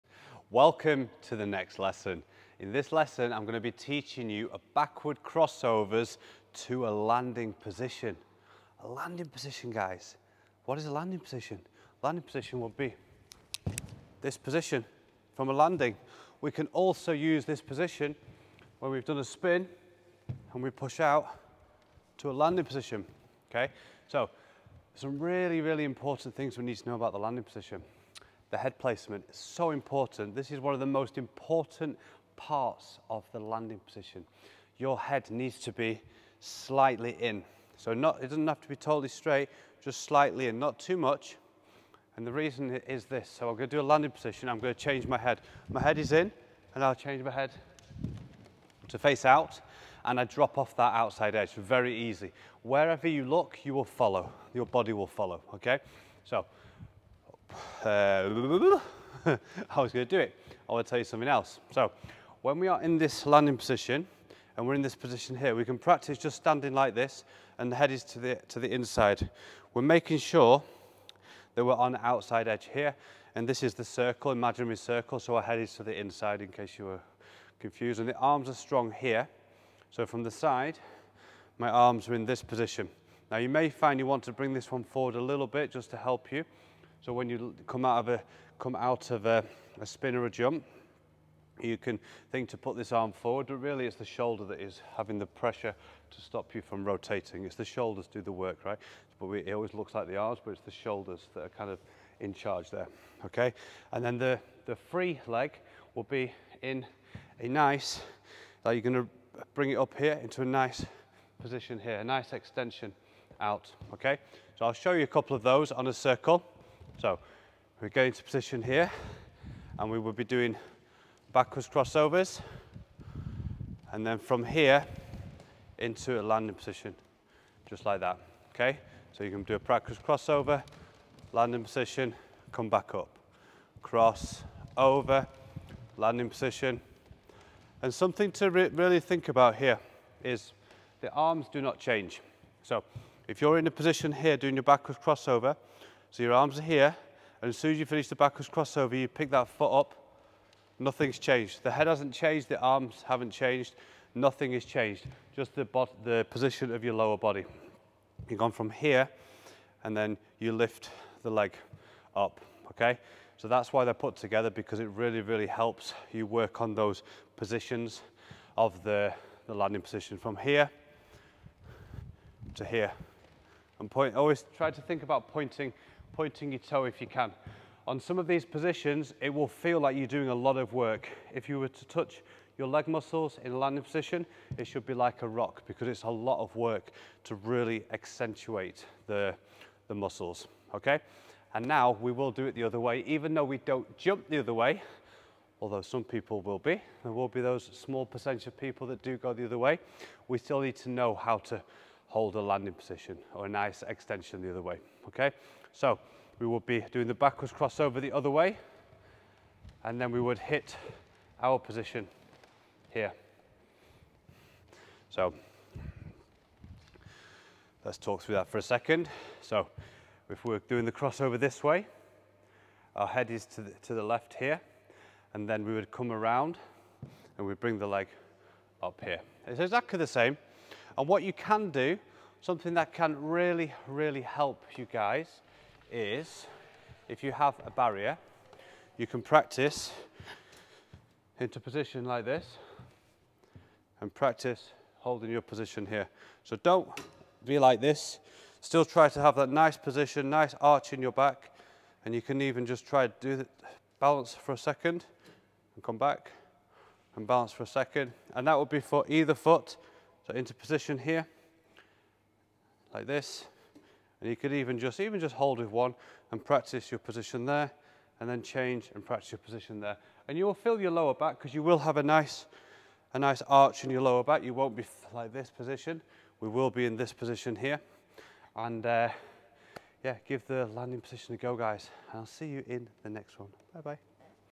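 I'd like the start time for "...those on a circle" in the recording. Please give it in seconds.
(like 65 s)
115 s.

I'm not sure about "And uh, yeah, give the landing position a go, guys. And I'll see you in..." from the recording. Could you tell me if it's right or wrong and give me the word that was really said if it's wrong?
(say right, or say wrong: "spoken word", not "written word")
right.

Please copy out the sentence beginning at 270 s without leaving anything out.
And you will feel your lower back because you will have a nice, a nice arch in your lower back.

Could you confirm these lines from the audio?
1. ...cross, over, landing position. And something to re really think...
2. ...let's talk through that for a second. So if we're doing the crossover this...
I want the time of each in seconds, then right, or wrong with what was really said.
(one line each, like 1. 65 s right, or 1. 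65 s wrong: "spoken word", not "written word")
1. 133 s right
2. 217 s right.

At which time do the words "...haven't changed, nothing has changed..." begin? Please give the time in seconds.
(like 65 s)
153 s.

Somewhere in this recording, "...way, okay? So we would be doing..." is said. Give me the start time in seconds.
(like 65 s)
204 s.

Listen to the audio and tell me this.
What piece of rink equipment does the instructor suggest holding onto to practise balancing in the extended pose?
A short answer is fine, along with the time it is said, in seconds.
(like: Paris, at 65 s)
A barrier, at 237 s.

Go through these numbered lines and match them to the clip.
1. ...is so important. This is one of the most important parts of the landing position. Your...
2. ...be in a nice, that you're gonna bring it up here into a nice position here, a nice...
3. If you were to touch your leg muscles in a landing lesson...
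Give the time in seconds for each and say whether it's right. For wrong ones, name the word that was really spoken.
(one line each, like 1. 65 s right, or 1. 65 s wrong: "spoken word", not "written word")
1. 29 s right
2. 106 s right
3. 181 s wrong: "position", not "lesson".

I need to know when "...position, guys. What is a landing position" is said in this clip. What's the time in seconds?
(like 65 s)
9 s.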